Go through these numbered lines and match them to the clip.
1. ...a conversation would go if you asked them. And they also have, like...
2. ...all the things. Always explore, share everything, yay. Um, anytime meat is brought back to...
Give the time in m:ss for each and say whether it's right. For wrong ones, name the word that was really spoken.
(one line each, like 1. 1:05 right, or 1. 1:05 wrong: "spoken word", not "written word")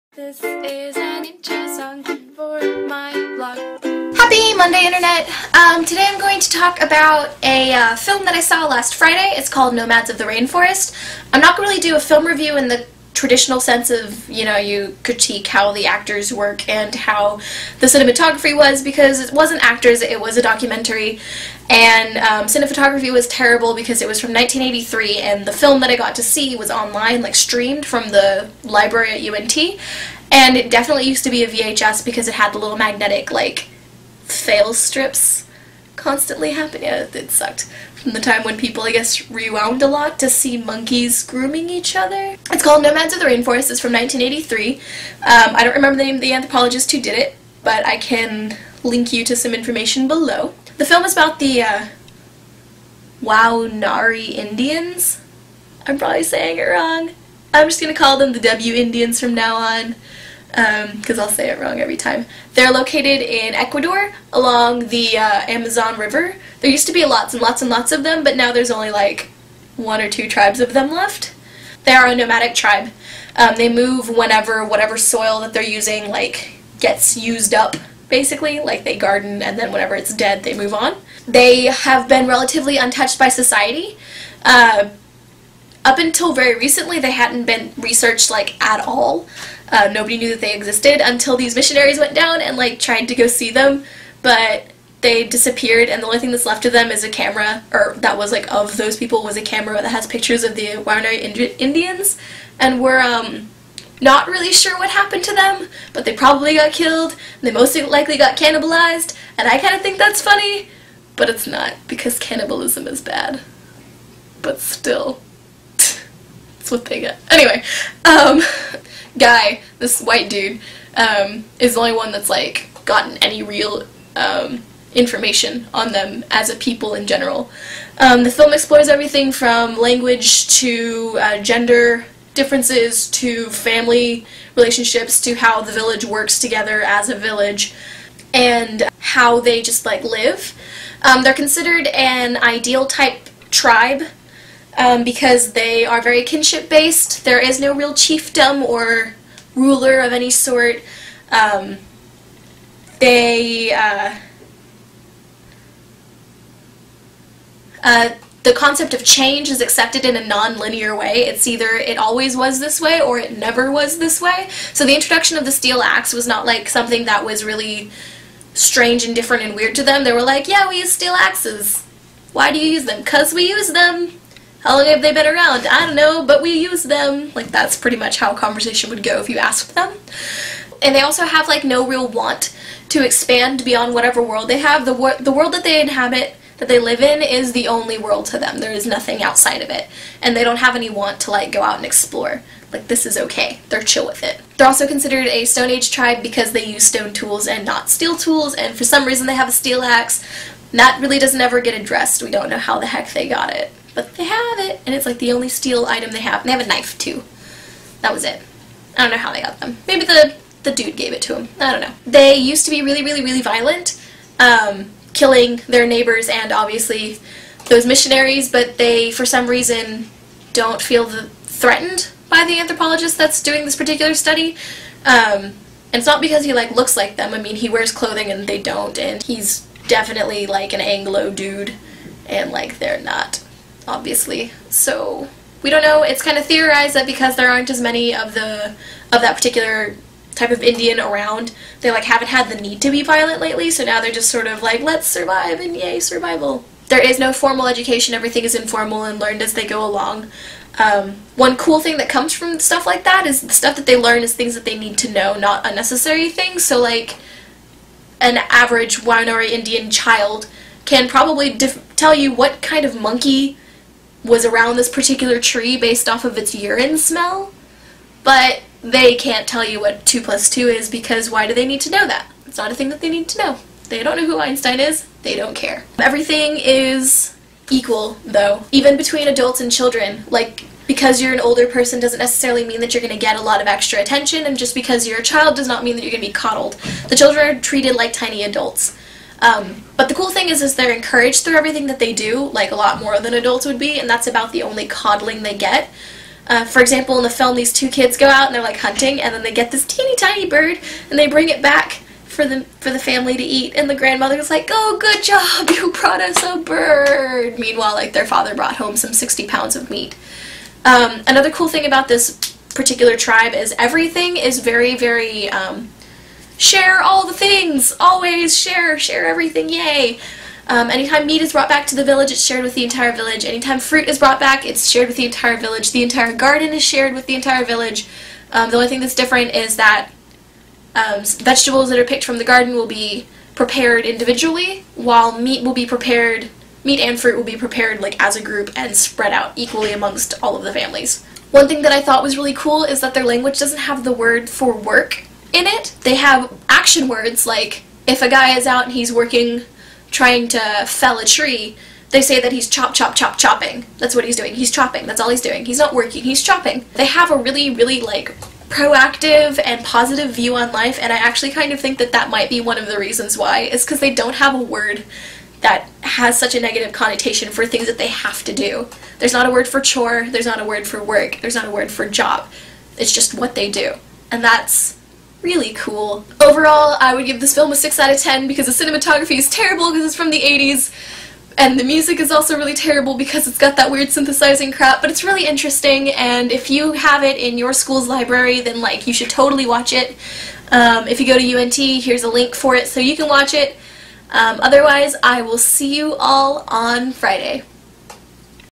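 1. 2:58 right
2. 5:17 wrong: "share", not "explore".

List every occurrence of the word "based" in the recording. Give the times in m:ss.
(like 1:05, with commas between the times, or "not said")
2:26, 4:25.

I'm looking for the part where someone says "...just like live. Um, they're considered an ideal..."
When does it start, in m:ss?
2:19.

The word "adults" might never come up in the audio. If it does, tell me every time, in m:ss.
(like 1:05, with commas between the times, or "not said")
4:39, 4:48, 4:53.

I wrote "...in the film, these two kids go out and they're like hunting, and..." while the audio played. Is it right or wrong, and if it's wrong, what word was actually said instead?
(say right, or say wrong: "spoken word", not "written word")
right.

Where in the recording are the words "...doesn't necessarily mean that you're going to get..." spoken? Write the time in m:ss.
4:41.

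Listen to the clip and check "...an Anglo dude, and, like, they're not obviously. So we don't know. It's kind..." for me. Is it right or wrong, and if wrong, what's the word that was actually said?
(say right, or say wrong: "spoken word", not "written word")
right.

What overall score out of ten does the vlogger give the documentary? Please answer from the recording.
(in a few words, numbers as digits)
6 out of 10.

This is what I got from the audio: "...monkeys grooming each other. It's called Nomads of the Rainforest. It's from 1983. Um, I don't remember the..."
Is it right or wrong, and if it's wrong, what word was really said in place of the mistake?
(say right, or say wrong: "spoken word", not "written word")
right.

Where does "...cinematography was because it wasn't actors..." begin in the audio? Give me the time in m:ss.
0:17.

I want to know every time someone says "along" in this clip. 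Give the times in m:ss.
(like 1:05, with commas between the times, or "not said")
1:04, 4:09.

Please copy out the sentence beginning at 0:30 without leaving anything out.
And it definitely used to be a VHS because it had the little magnetic, like, fail strips constantly happen.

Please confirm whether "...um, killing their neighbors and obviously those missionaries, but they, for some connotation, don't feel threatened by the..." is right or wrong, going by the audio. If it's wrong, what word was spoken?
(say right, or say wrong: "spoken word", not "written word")
wrong: "reason", not "connotation".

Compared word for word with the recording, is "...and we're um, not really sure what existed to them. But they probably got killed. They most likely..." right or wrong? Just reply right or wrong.
wrong.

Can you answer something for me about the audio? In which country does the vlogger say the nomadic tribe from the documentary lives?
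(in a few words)
Ecuador.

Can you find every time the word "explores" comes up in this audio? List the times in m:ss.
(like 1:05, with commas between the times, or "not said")
2:08, 3:11.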